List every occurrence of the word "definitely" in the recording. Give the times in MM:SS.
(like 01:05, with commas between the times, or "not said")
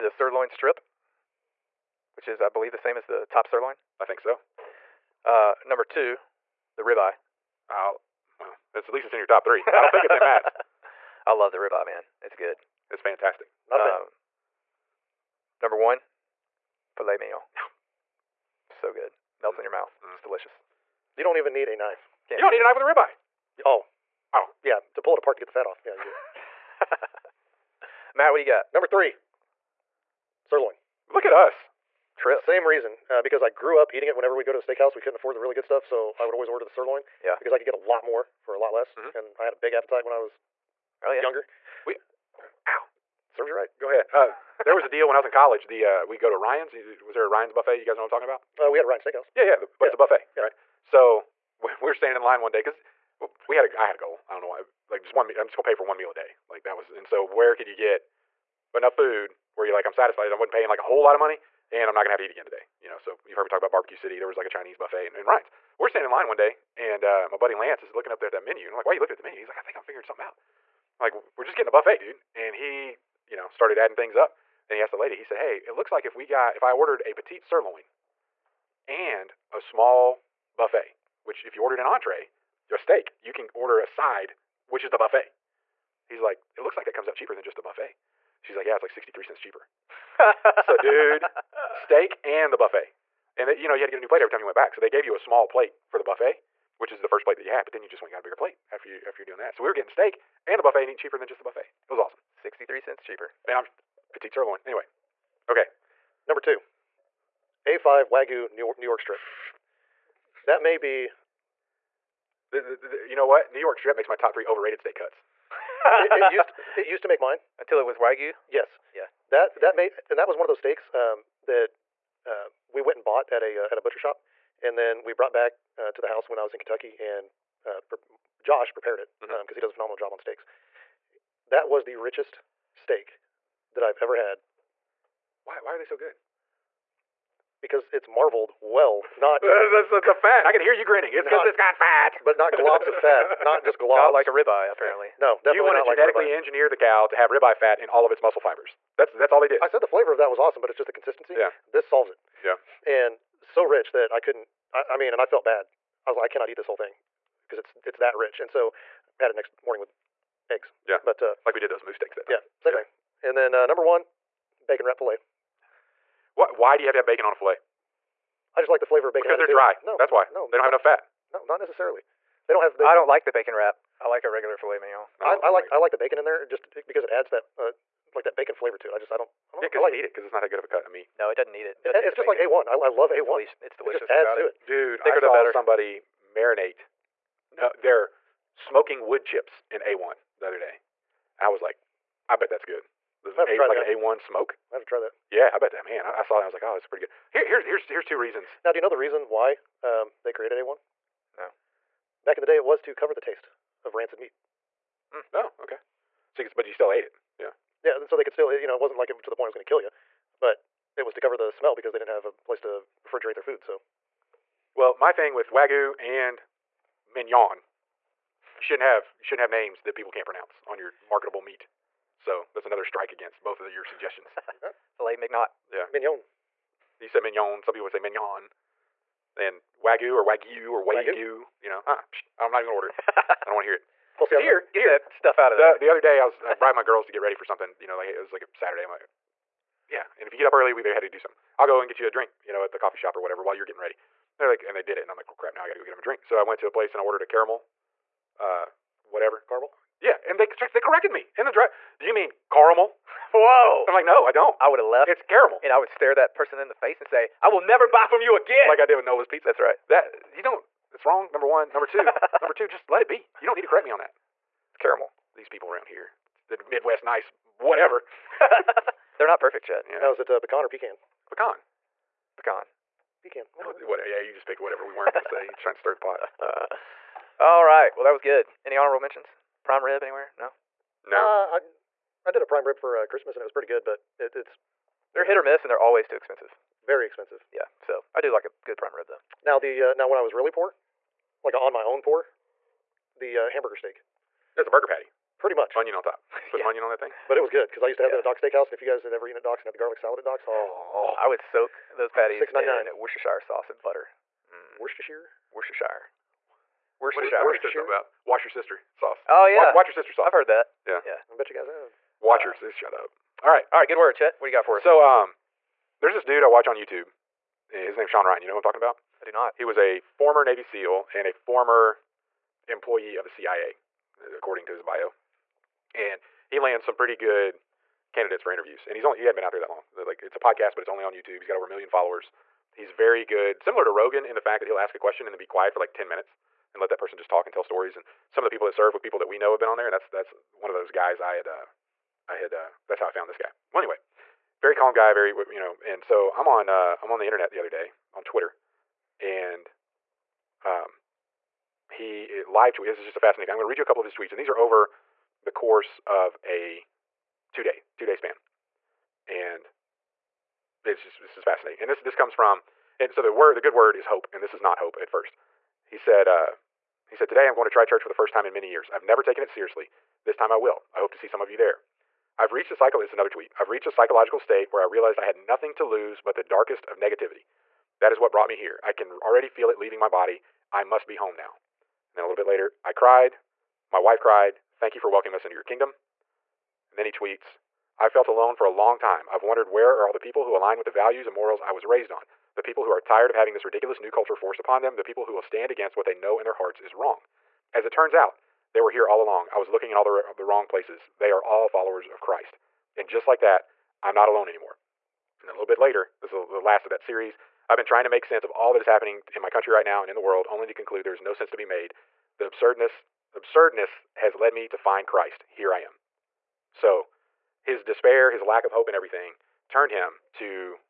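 02:25.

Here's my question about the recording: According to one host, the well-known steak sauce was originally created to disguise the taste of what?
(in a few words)
Rancid meat.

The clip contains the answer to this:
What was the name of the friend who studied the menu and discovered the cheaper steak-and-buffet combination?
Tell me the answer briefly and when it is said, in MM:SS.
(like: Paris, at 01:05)
Lance, at 01:07.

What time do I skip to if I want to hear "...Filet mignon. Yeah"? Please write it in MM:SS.
03:44.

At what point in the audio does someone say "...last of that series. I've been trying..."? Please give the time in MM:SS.
06:46.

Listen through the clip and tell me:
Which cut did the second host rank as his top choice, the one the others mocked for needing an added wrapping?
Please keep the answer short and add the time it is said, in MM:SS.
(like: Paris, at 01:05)
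Bacon wrap filet, at 02:44.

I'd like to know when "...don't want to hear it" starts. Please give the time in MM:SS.
03:53.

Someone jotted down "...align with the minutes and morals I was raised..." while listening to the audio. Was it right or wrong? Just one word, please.
wrong.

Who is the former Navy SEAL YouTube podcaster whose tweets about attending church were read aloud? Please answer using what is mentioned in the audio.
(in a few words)
Sean Ryan.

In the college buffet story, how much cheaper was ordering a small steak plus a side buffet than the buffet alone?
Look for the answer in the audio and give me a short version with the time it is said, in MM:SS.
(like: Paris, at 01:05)
63 cents, at 01:28.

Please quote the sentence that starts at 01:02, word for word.
You know, so you've heard me talk about Barbecue City.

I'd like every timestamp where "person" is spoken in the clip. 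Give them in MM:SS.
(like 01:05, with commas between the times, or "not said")
04:16, 05:36.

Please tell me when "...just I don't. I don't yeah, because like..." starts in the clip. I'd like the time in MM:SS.
02:58.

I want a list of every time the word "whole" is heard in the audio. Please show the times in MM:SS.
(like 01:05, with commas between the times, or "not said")
01:00, 02:36.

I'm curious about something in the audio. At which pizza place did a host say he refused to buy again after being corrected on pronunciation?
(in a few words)
Nola's Pizza.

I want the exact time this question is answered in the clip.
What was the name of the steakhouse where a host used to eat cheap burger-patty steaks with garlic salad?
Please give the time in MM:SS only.
04:58.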